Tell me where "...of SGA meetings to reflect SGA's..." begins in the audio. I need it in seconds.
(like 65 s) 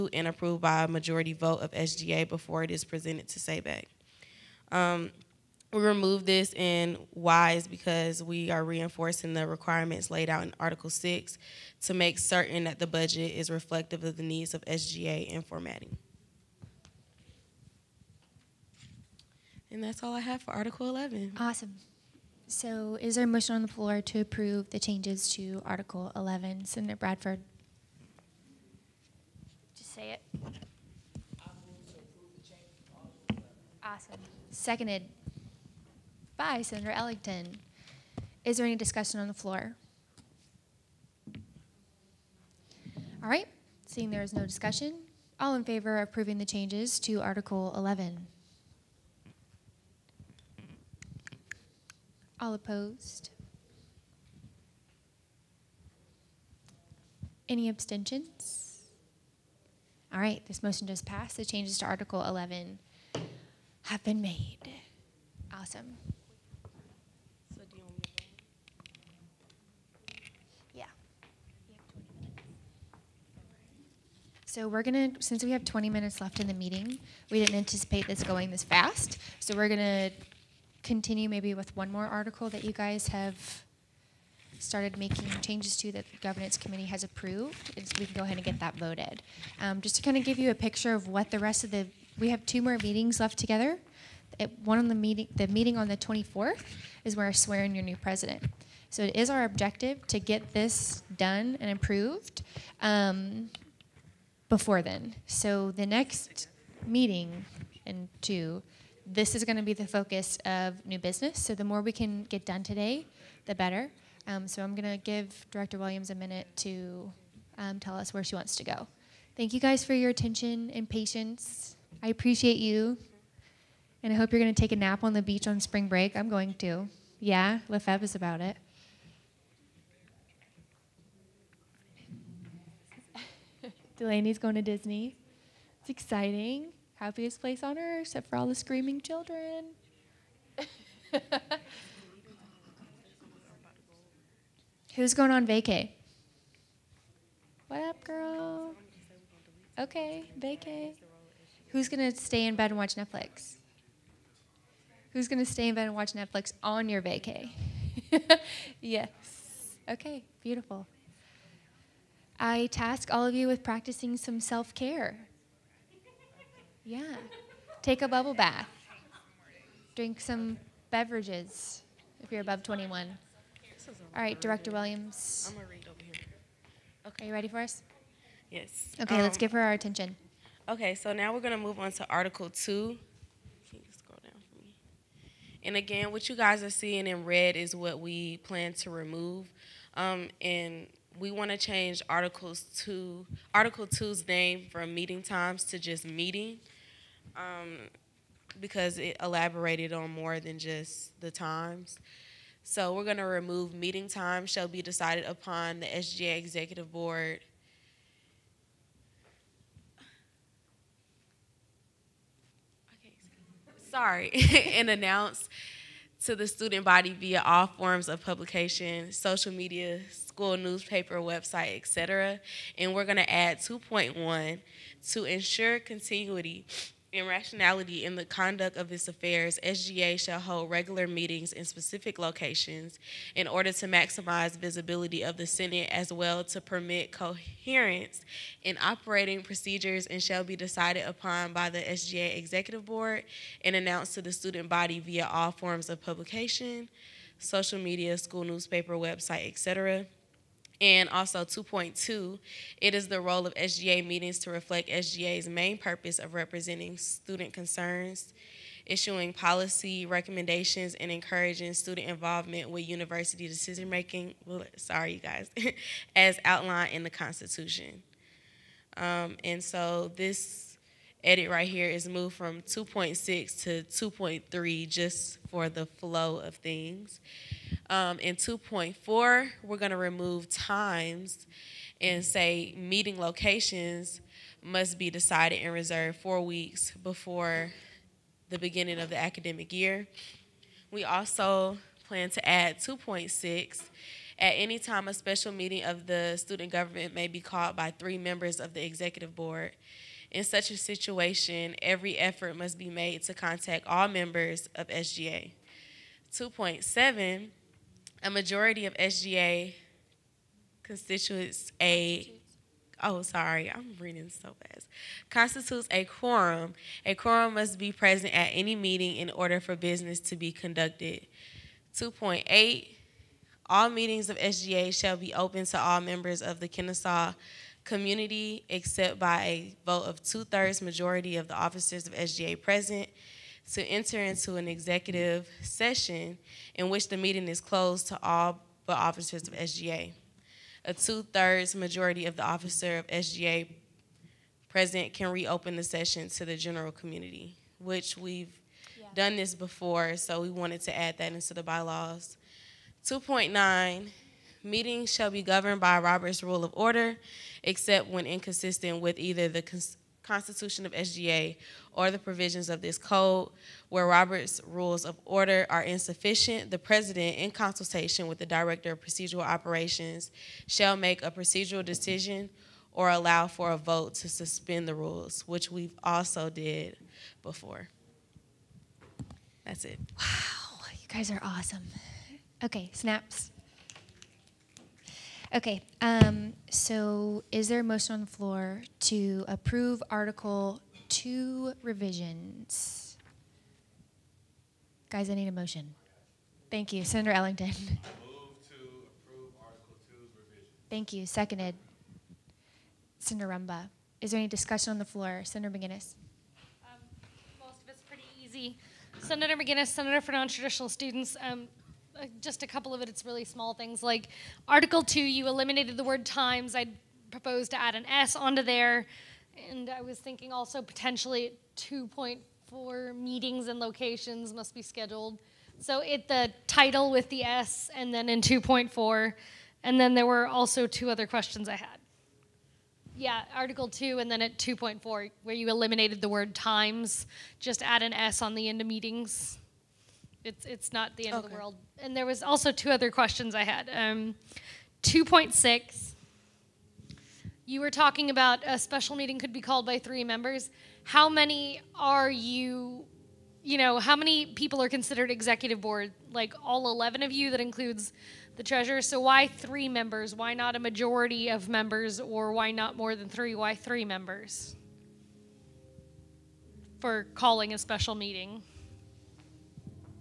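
253 s.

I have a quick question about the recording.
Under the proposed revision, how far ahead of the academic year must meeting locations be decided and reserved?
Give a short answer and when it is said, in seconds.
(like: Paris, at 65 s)
4 weeks, at 286 s.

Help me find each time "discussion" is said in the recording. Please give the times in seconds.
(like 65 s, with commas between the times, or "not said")
38 s, 44 s, 404 s.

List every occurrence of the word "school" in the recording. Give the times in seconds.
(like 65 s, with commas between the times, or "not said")
220 s, 248 s.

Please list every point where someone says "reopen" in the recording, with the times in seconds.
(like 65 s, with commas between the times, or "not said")
345 s.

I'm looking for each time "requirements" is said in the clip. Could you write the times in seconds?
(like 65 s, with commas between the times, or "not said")
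9 s.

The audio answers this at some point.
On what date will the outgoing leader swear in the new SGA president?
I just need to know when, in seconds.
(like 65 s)
95 s.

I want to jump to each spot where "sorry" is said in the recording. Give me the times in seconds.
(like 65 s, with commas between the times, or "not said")
213 s, 264 s, 313 s.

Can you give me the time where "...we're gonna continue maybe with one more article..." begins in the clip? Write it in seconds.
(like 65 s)
79 s.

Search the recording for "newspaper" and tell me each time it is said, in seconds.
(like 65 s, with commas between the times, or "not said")
220 s, 248 s.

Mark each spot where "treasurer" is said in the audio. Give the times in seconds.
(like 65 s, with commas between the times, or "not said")
458 s.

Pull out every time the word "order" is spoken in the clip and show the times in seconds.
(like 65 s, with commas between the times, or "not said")
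233 s, 319 s, 356 s, 365 s.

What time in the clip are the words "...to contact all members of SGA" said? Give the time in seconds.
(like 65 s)
303 s.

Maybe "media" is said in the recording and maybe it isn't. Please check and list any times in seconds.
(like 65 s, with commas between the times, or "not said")
219 s, 247 s.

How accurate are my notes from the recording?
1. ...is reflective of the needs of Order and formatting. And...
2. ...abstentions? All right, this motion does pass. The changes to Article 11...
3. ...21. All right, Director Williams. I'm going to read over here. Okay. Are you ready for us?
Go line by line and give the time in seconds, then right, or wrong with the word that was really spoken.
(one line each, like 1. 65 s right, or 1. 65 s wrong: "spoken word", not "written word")
1. 13 s wrong: "SGA", not "Order"
2. 57 s right
3. 172 s right.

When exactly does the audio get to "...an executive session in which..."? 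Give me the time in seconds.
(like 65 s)
334 s.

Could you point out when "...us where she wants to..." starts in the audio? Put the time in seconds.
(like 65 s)
117 s.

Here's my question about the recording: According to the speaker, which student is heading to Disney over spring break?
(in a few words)
Delaney.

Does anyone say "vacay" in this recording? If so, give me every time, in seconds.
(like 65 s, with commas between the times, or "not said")
145 s, 150 s, 157 s.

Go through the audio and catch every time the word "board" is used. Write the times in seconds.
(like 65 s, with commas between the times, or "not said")
206 s, 242 s, 299 s, 455 s.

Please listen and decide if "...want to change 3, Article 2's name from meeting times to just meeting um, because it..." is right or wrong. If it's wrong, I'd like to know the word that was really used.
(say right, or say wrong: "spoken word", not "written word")
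wrong: "2", not "3".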